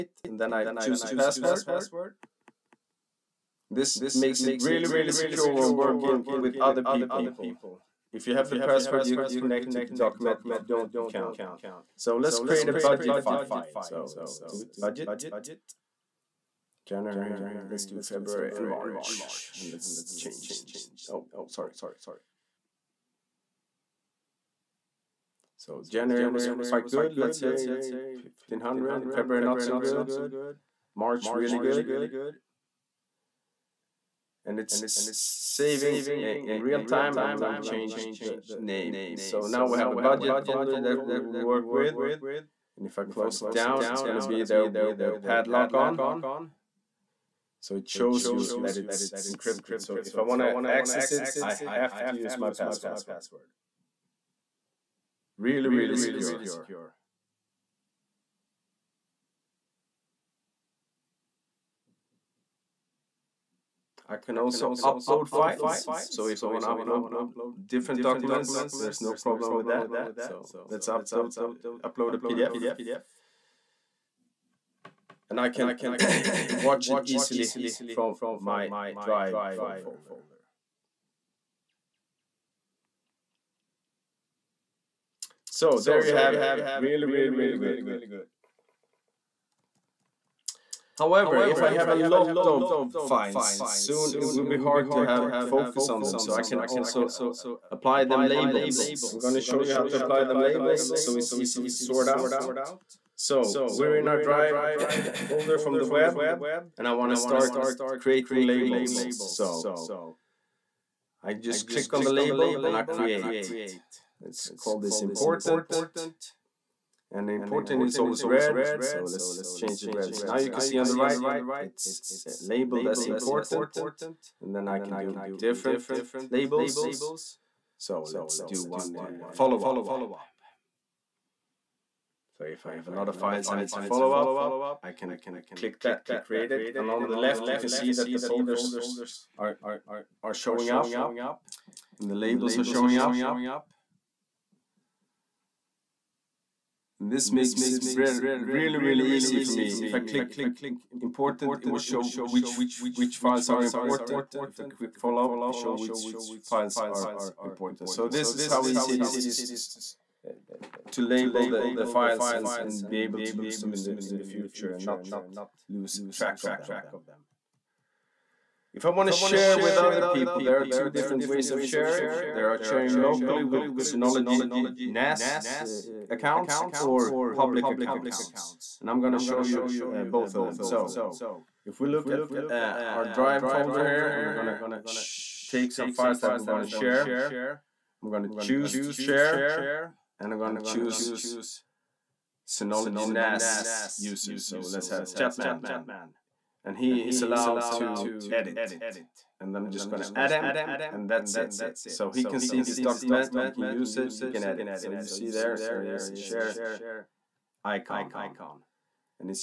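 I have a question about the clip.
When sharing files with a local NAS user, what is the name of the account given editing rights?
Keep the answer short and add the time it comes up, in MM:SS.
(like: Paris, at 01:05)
Chatman, at 03:15.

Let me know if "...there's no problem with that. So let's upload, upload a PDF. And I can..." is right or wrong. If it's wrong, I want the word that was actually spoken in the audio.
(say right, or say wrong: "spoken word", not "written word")
right.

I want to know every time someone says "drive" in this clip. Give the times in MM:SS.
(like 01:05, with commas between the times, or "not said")
01:19, 01:44, 03:03.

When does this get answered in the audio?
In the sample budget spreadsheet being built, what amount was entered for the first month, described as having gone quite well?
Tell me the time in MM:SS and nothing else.
00:28.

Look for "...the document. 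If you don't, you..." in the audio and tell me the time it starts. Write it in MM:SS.
00:09.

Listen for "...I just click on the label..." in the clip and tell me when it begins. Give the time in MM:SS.
01:51.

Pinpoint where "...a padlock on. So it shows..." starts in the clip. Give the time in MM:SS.
00:45.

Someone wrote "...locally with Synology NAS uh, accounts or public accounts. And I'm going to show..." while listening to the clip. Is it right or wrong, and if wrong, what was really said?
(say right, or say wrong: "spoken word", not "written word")
right.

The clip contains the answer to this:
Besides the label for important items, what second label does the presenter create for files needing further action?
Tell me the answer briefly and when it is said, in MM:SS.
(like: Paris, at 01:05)
Follow-up, at 02:09.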